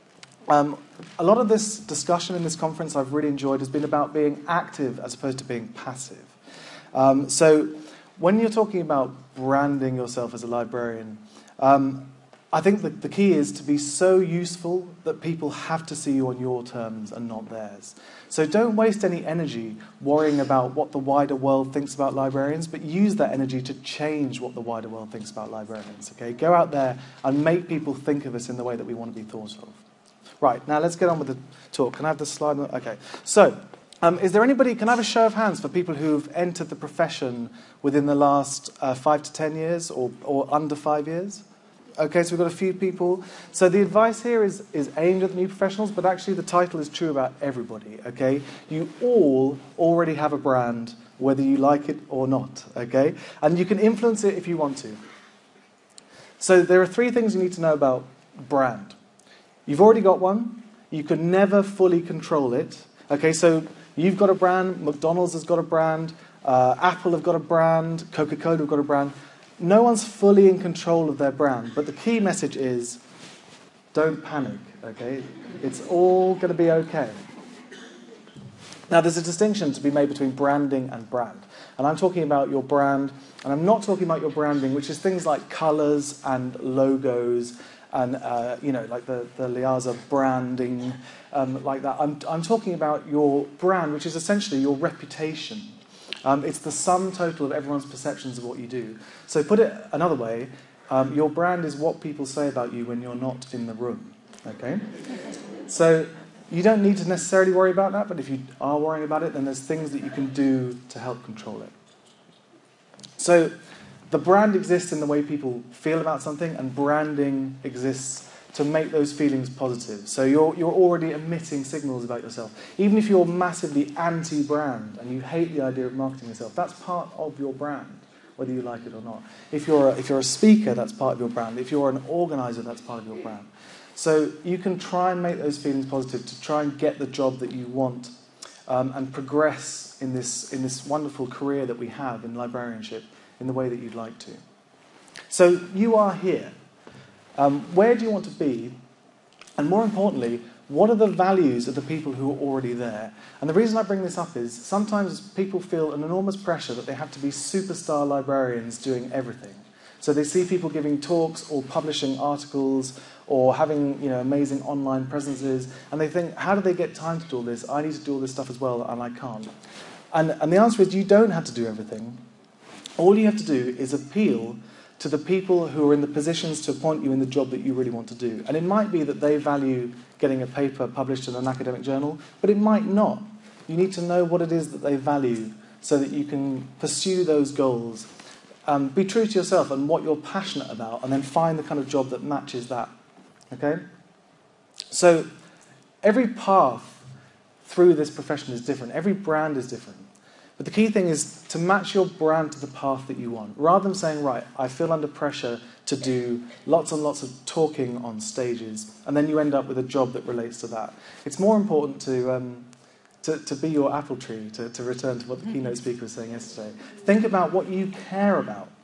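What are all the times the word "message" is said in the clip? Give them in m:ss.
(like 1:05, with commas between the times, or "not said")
1:12.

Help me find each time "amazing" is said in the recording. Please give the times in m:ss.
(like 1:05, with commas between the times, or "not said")
2:44.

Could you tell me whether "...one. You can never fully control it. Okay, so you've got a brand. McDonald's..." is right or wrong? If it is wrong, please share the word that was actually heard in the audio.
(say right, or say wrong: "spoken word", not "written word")
right.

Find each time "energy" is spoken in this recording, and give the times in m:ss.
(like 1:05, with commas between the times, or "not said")
0:19, 0:23.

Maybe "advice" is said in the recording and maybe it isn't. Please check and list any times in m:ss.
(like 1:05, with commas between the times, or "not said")
0:43.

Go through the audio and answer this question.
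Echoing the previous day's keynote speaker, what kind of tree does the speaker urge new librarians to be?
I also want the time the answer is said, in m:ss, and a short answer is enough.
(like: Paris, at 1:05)
Apple tree, at 3:33.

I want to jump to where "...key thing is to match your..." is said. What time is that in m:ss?
3:20.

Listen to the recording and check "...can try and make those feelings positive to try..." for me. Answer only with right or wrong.
right.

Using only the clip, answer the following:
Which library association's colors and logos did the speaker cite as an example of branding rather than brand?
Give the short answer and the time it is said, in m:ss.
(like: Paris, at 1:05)
LIASA, at 1:29.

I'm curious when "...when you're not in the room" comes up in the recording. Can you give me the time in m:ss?
1:42.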